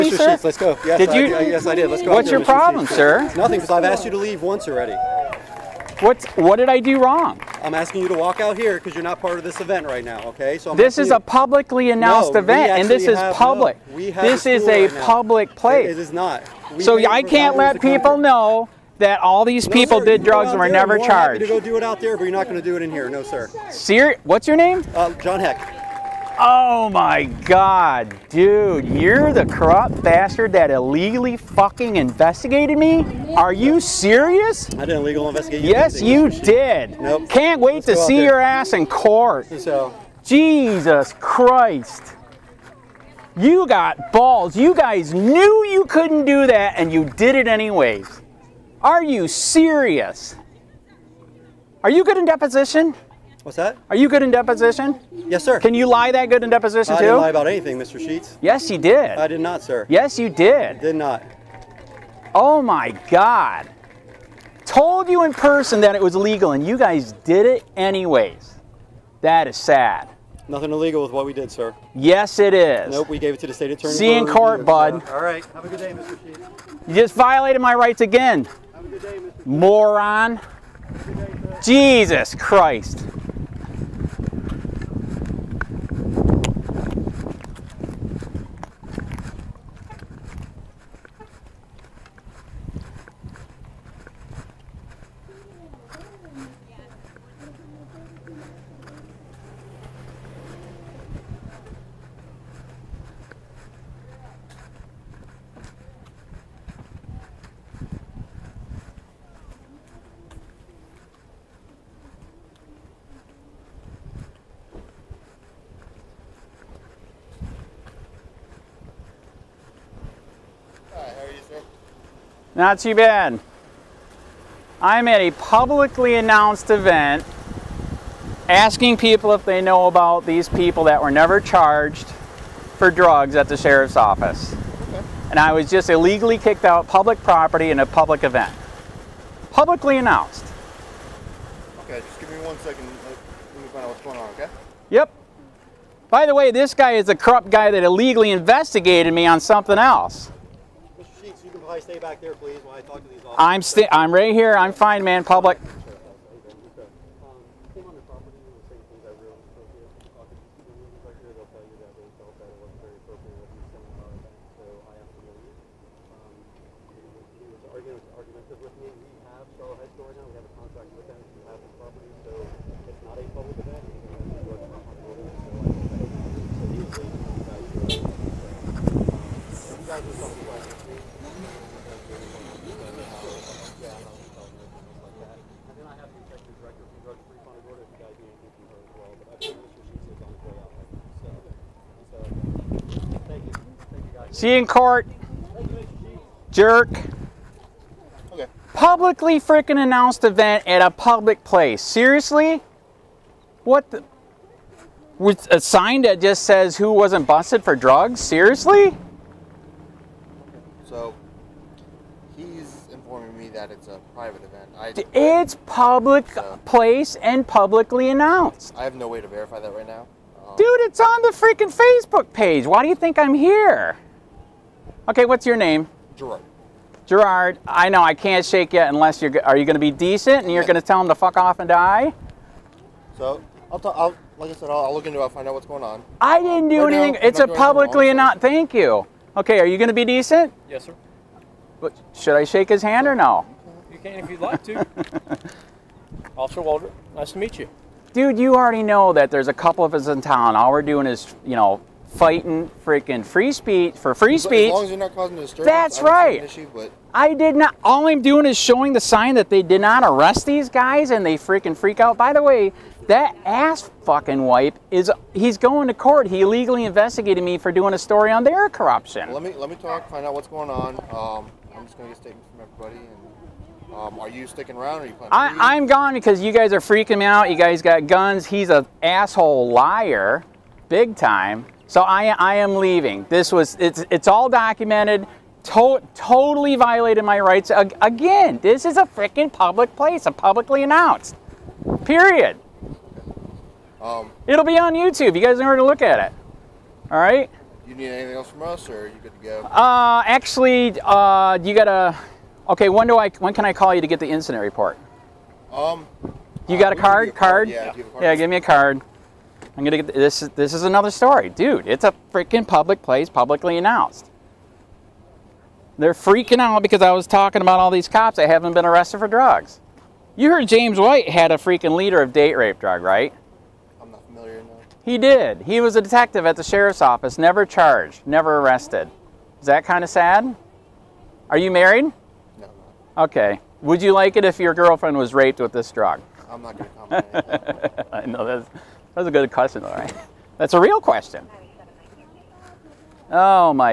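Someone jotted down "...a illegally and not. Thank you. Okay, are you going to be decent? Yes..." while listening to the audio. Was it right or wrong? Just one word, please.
wrong.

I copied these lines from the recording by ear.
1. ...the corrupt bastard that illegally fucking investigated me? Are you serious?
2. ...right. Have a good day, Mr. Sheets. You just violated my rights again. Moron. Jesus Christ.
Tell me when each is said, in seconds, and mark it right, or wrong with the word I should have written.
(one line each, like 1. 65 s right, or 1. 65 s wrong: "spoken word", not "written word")
1. 29 s right
2. 75 s right.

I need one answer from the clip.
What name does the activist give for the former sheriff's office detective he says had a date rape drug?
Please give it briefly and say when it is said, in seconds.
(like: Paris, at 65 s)
James White, at 320 s.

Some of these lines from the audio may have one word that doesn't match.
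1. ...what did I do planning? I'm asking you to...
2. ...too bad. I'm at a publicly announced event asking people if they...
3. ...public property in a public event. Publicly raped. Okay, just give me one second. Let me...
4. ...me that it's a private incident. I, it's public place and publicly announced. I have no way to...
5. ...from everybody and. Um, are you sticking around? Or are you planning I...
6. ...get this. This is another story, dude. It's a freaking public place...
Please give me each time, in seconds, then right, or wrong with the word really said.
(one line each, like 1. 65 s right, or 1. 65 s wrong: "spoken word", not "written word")
1. 6 s wrong: "wrong", not "planning"
2. 122 s right
3. 136 s wrong: "announced", not "raped"
4. 213 s wrong: "event", not "incident"
5. 272 s right
6. 310 s right.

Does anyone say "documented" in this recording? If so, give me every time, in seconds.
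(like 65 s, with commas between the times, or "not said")
284 s.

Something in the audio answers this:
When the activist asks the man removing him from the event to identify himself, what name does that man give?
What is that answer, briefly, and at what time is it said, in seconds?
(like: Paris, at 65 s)
John Heck, at 25 s.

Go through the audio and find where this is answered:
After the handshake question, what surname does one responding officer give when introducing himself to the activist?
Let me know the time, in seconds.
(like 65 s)
246 s.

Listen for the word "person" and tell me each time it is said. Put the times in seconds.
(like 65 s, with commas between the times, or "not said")
65 s.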